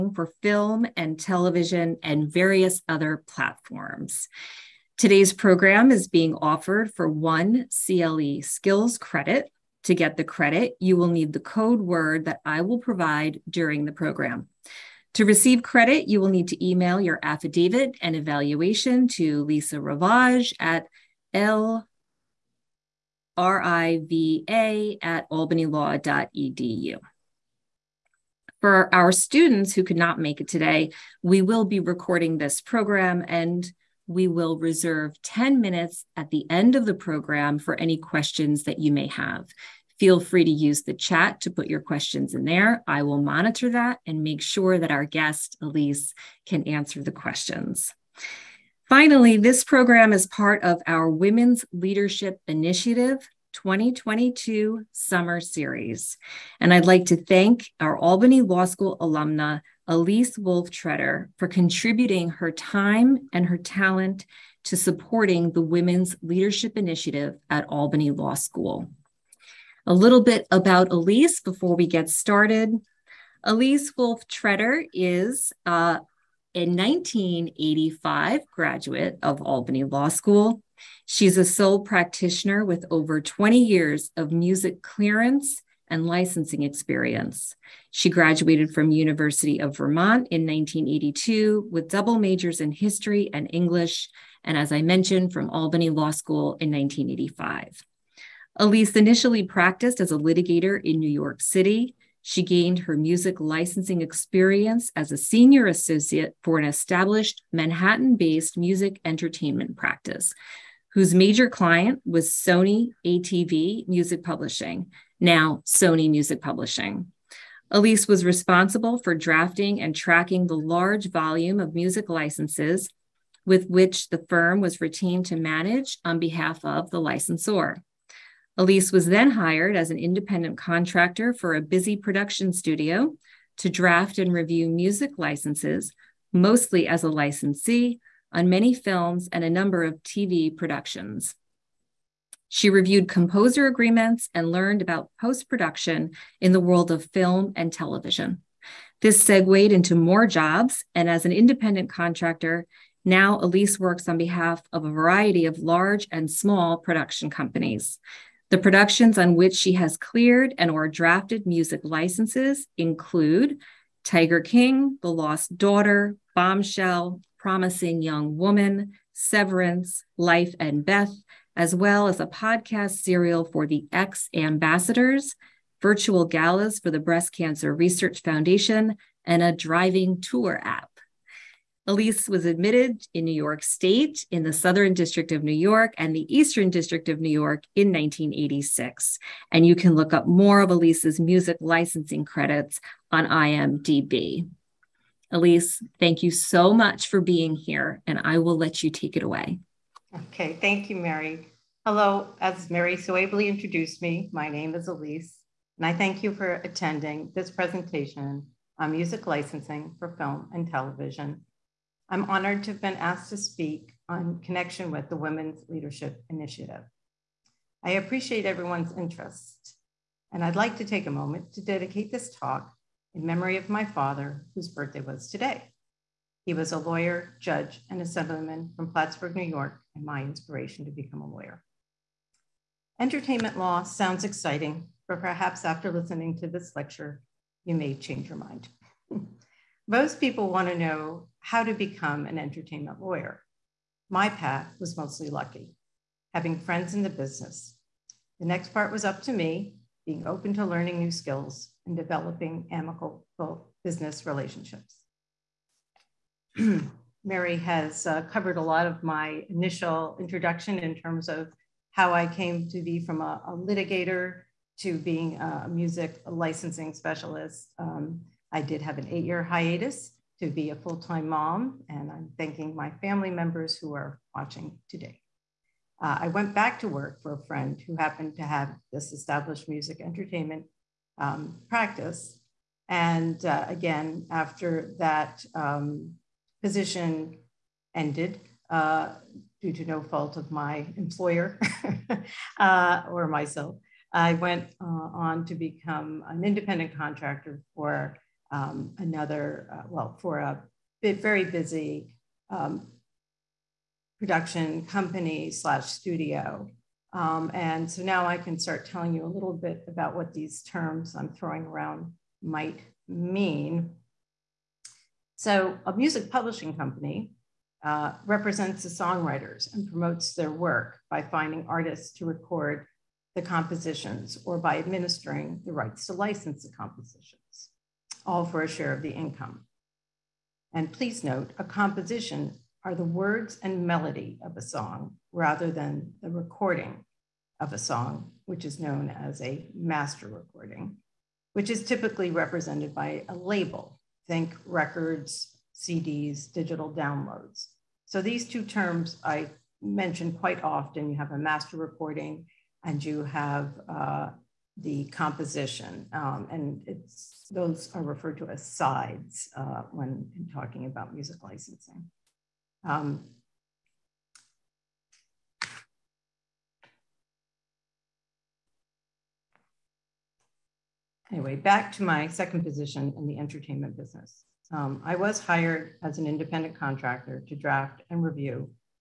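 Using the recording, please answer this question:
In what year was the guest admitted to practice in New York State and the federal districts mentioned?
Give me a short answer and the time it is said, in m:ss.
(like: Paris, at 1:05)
1986, at 3:07.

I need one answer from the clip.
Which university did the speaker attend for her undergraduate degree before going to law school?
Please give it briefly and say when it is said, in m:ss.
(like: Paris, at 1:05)
University of Vermont, at 1:28.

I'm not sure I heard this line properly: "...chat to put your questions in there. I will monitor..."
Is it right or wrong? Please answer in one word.
right.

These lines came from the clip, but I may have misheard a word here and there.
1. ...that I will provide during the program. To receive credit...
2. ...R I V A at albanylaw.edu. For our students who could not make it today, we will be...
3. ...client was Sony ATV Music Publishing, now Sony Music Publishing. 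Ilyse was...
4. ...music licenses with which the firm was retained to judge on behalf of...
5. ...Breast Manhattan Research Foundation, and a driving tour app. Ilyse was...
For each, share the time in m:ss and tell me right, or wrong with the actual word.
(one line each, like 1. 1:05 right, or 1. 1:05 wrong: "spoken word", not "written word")
1. 0:12 right
2. 0:23 right
3. 1:51 right
4. 2:01 wrong: "manage", not "judge"
5. 2:56 wrong: "Cancer", not "Manhattan".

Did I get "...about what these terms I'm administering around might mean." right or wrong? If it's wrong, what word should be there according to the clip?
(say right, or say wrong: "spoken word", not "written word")
wrong: "throwing", not "administering".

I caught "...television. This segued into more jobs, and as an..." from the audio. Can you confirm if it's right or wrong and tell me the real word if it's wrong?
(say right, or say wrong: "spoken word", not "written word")
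right.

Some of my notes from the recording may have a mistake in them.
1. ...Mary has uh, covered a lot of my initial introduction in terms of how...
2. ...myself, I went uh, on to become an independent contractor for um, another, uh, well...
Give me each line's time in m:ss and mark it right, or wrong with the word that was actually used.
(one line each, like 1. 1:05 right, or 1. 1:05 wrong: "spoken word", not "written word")
1. 4:17 right
2. 4:53 right.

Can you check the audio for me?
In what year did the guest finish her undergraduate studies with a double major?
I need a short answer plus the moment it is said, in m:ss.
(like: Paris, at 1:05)
1982, at 1:30.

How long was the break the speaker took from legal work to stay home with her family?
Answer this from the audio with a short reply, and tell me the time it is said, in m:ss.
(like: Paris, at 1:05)
8 years, at 4:29.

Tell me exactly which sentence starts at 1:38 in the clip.
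Ilyse initially practiced as a litigator in New York City.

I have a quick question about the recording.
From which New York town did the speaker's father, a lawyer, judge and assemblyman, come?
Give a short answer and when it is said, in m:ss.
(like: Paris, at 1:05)
Plattsburgh, at 3:48.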